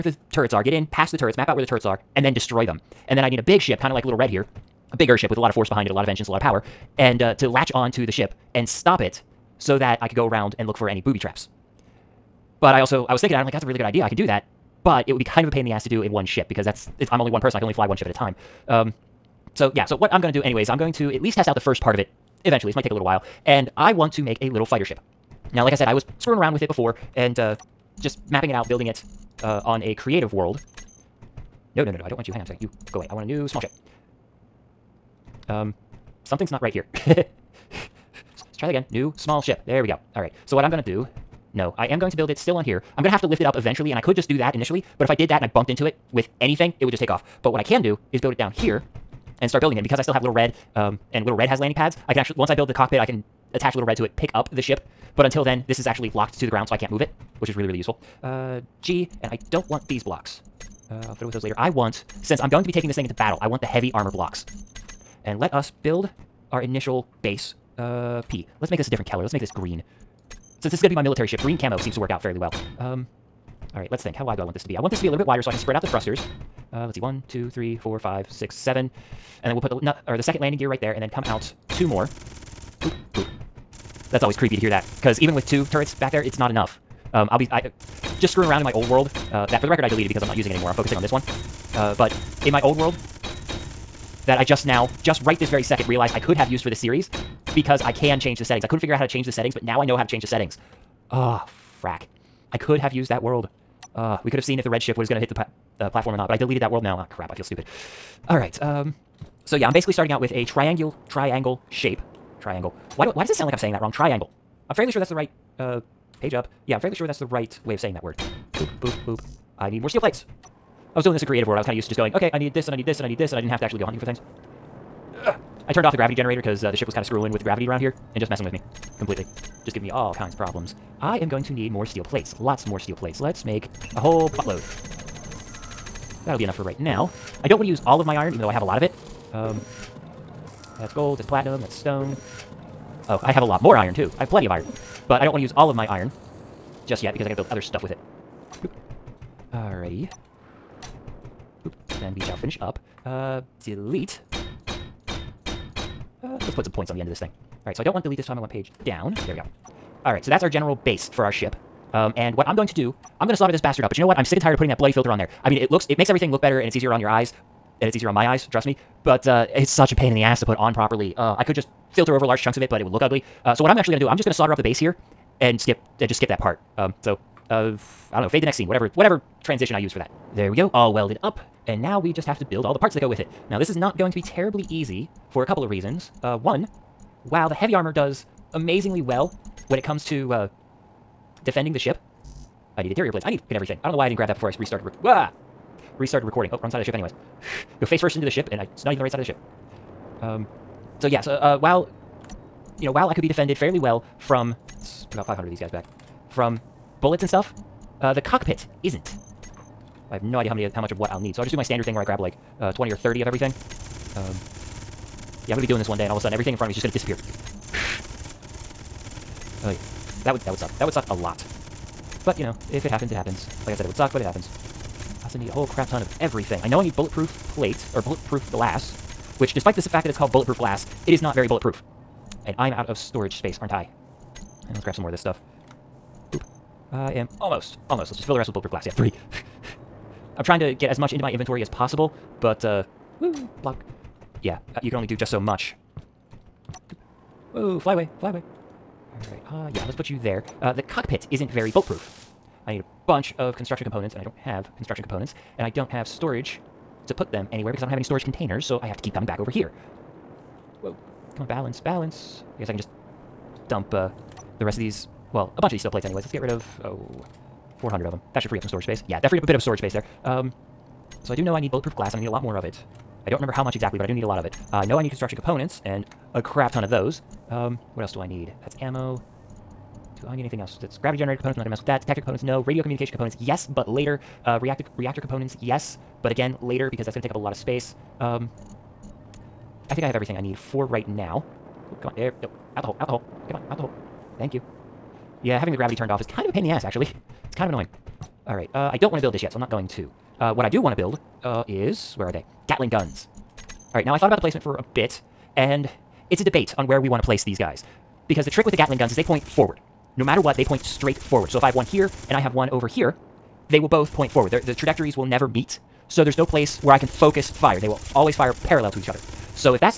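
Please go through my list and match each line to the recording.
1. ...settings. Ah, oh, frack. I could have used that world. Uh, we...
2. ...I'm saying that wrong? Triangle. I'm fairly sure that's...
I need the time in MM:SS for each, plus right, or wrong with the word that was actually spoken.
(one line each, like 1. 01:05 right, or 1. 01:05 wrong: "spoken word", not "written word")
1. 01:40 right
2. 01:53 right.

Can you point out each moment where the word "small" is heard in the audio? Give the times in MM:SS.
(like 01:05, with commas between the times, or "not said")
00:33, 00:39.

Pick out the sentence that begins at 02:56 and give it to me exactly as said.
Um, so, uh, I don't know, fade to next scene, whatever, whatever transition I use for that.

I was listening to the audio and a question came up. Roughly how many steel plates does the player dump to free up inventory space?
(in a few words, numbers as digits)
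400.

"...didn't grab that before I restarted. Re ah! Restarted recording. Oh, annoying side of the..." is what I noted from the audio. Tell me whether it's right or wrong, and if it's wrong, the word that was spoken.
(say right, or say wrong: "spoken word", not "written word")
wrong: "wrong", not "annoying".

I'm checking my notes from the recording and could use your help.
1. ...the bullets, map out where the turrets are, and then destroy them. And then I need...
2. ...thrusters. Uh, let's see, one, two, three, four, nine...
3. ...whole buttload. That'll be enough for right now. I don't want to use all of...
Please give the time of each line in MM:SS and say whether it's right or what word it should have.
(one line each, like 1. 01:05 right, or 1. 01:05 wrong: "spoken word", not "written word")
1. 00:01 wrong: "turrets", not "bullets"
2. 01:15 wrong: "five", not "nine"
3. 02:14 right.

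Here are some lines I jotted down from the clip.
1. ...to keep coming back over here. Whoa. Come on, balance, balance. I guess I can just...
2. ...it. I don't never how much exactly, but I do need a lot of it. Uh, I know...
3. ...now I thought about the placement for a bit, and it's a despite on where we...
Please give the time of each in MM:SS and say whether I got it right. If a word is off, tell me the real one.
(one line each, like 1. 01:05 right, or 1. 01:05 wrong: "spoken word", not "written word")
1. 04:18 right
2. 04:32 wrong: "remember", not "never"
3. 05:04 wrong: "debate", not "despite".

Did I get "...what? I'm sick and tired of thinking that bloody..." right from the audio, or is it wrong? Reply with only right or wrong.
wrong.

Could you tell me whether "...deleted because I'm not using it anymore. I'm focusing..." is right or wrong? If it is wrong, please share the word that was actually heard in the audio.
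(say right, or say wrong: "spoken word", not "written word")
right.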